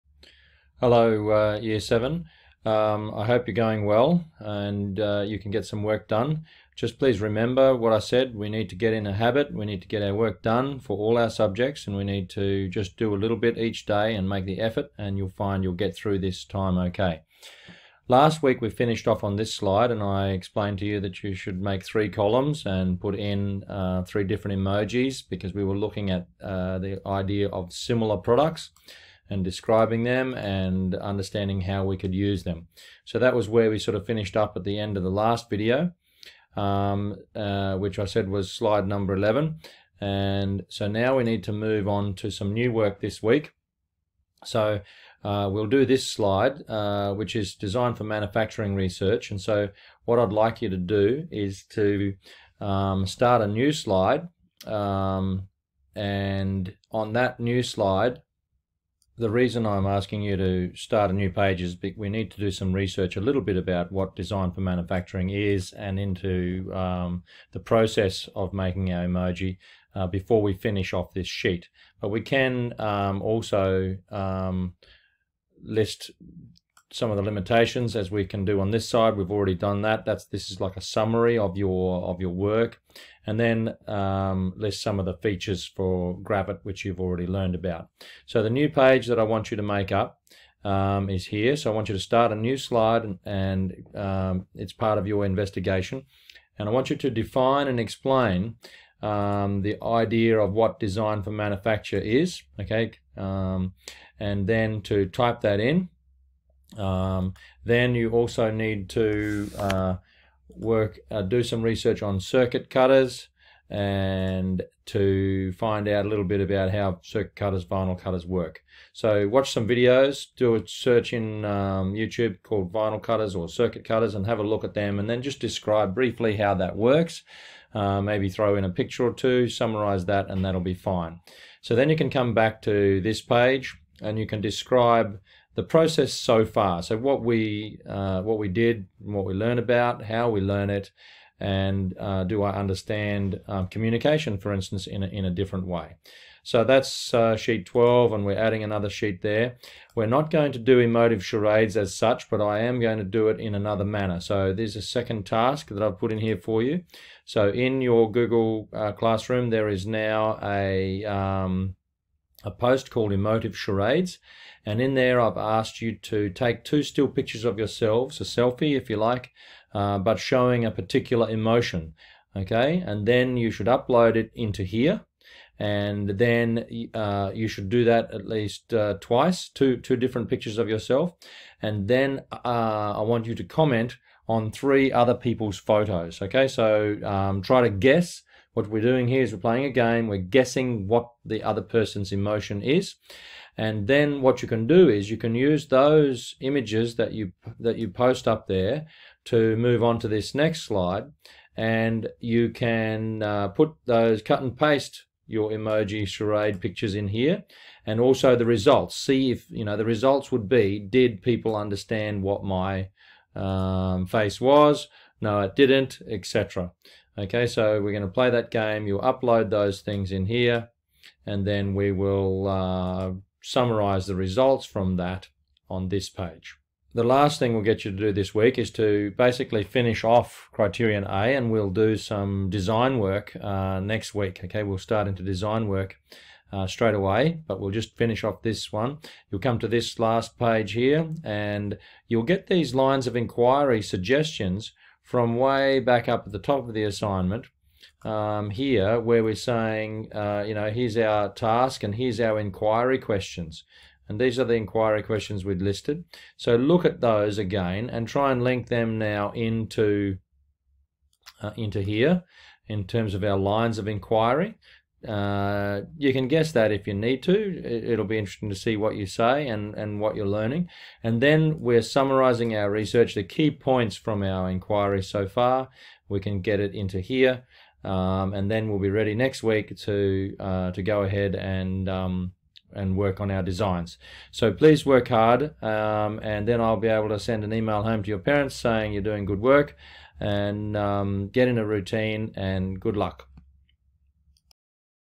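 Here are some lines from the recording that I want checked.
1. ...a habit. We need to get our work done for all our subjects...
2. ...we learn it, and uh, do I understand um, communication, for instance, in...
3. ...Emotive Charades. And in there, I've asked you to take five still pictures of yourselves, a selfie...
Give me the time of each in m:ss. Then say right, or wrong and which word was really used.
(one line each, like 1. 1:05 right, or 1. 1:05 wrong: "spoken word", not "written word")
1. 0:09 right
2. 2:20 right
3. 2:43 wrong: "two", not "five".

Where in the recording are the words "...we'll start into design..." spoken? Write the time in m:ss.
3:54.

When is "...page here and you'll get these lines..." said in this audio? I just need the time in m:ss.
4:00.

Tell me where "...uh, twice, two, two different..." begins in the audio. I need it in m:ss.
2:58.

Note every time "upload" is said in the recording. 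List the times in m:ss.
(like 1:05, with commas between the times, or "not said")
2:53, 3:38.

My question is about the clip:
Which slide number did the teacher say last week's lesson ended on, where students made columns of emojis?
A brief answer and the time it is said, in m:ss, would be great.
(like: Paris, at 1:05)
11, at 0:38.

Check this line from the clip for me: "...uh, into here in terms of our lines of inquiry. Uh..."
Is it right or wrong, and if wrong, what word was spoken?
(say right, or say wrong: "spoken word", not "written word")
right.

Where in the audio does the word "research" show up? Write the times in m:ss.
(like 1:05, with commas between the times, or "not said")
0:48, 1:02, 1:51, 4:32.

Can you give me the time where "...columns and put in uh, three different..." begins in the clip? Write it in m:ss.
0:22.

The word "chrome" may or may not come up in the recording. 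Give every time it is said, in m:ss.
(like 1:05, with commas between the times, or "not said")
not said.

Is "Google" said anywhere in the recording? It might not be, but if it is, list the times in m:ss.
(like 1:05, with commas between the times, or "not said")
2:38.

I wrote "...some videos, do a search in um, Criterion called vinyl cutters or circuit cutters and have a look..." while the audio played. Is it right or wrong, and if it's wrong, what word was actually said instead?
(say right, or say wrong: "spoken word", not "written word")
wrong: "YouTube", not "Criterion".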